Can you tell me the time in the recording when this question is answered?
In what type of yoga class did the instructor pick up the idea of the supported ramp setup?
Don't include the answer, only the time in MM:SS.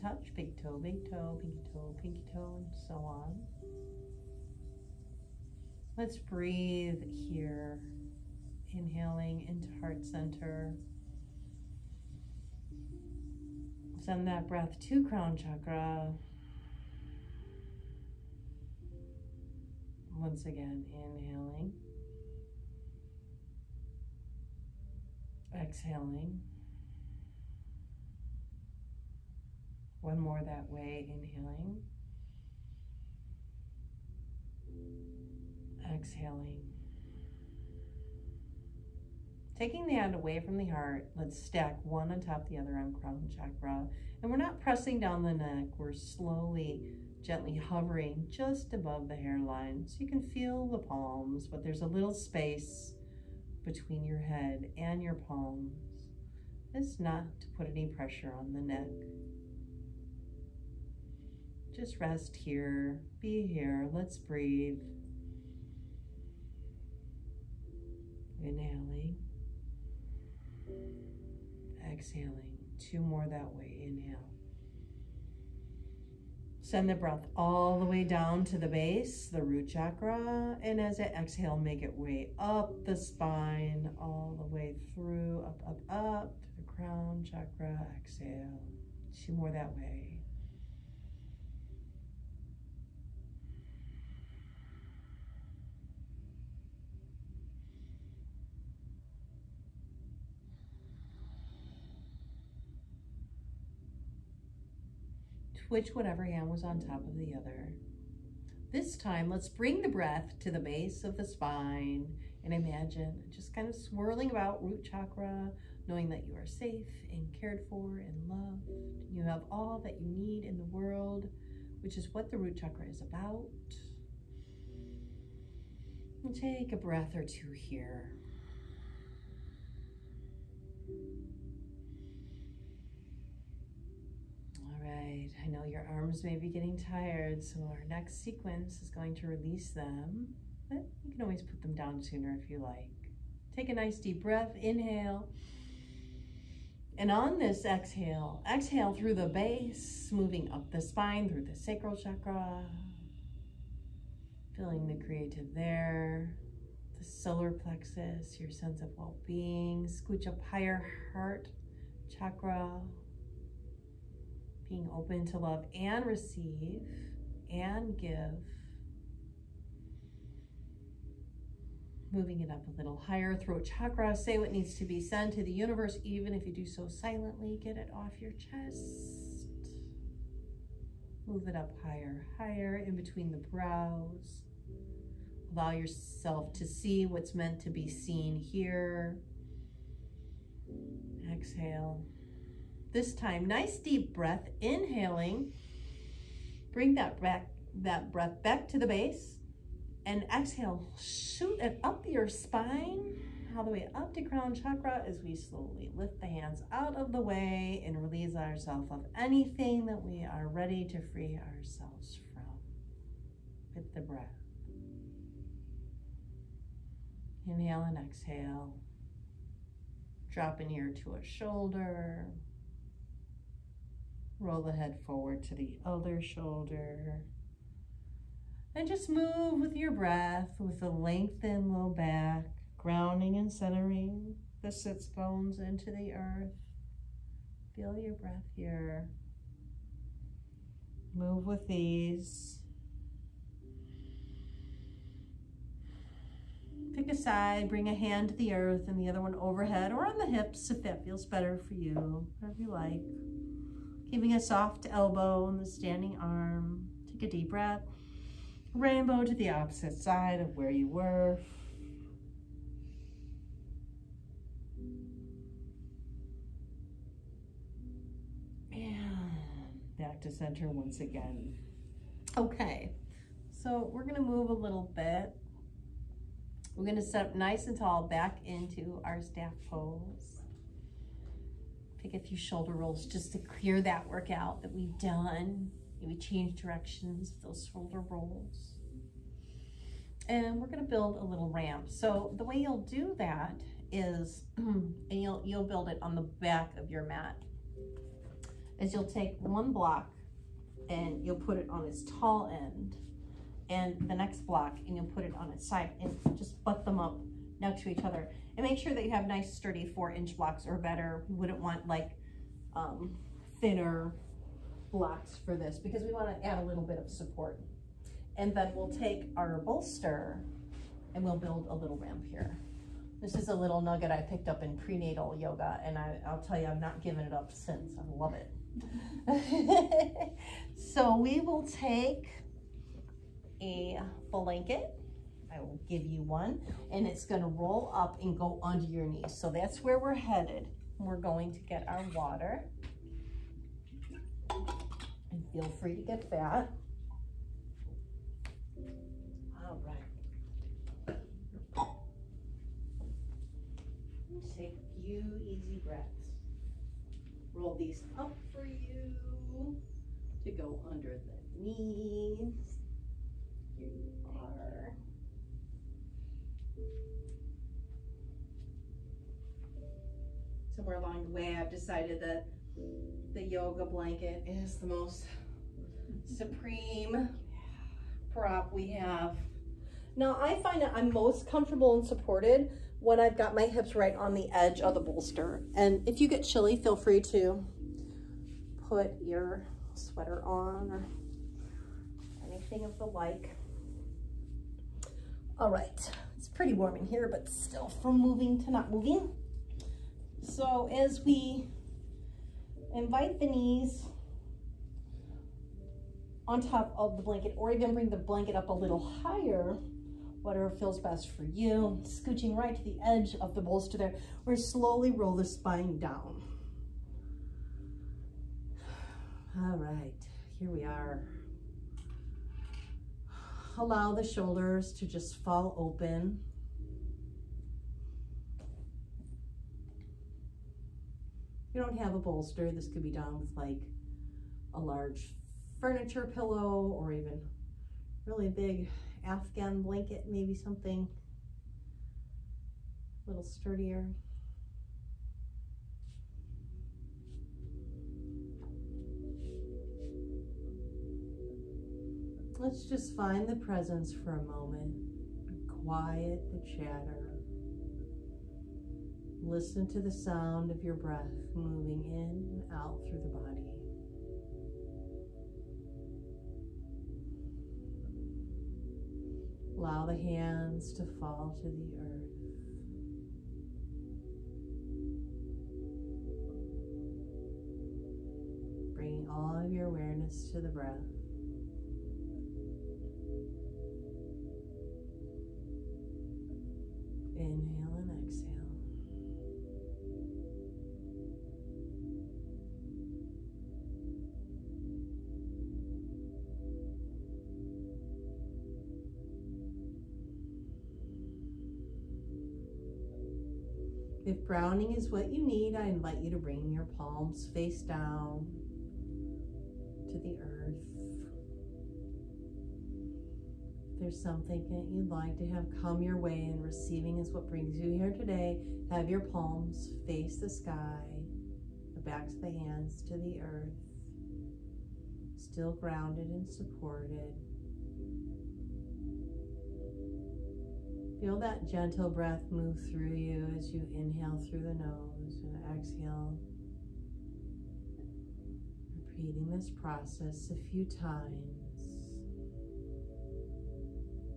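05:24.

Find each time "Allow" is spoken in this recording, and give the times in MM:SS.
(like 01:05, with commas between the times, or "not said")
03:05, 07:03, 07:49.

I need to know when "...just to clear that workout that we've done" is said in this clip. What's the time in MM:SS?
04:43.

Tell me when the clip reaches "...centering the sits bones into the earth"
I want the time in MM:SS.
03:53.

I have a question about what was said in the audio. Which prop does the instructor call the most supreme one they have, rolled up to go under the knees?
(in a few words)
Yoga blanket.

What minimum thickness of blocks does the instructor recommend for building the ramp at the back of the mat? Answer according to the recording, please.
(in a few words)
4 inches.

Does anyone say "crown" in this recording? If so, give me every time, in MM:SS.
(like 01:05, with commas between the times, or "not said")
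00:15, 00:42, 01:26, 03:24.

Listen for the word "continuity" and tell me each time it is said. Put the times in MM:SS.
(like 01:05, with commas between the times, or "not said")
not said.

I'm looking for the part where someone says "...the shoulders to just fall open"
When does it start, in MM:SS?
07:04.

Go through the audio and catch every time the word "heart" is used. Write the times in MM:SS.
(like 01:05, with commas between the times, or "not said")
00:09, 00:40, 02:41.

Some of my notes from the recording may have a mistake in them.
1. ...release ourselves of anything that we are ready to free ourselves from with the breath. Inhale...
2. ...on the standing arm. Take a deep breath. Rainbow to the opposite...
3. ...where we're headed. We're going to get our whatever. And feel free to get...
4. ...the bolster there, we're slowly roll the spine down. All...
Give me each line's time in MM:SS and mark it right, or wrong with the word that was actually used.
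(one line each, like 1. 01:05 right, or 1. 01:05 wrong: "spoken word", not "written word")
1. 03:28 right
2. 04:15 right
3. 05:39 wrong: "water", not "whatever"
4. 06:53 right.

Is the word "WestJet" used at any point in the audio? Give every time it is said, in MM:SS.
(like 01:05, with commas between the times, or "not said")
not said.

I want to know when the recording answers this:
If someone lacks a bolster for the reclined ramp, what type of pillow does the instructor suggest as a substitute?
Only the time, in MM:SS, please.
07:14.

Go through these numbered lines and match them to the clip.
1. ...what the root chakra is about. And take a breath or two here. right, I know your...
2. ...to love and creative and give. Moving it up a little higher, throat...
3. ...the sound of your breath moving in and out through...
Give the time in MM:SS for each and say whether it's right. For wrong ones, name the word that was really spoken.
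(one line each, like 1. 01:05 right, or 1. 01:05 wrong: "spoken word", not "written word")
1. 02:02 right
2. 02:45 wrong: "receive", not "creative"
3. 07:39 right.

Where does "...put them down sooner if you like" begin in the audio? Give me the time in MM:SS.
02:21.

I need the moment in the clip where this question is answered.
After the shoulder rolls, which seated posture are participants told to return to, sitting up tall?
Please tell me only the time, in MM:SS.
04:39.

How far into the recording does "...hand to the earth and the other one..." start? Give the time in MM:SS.
04:07.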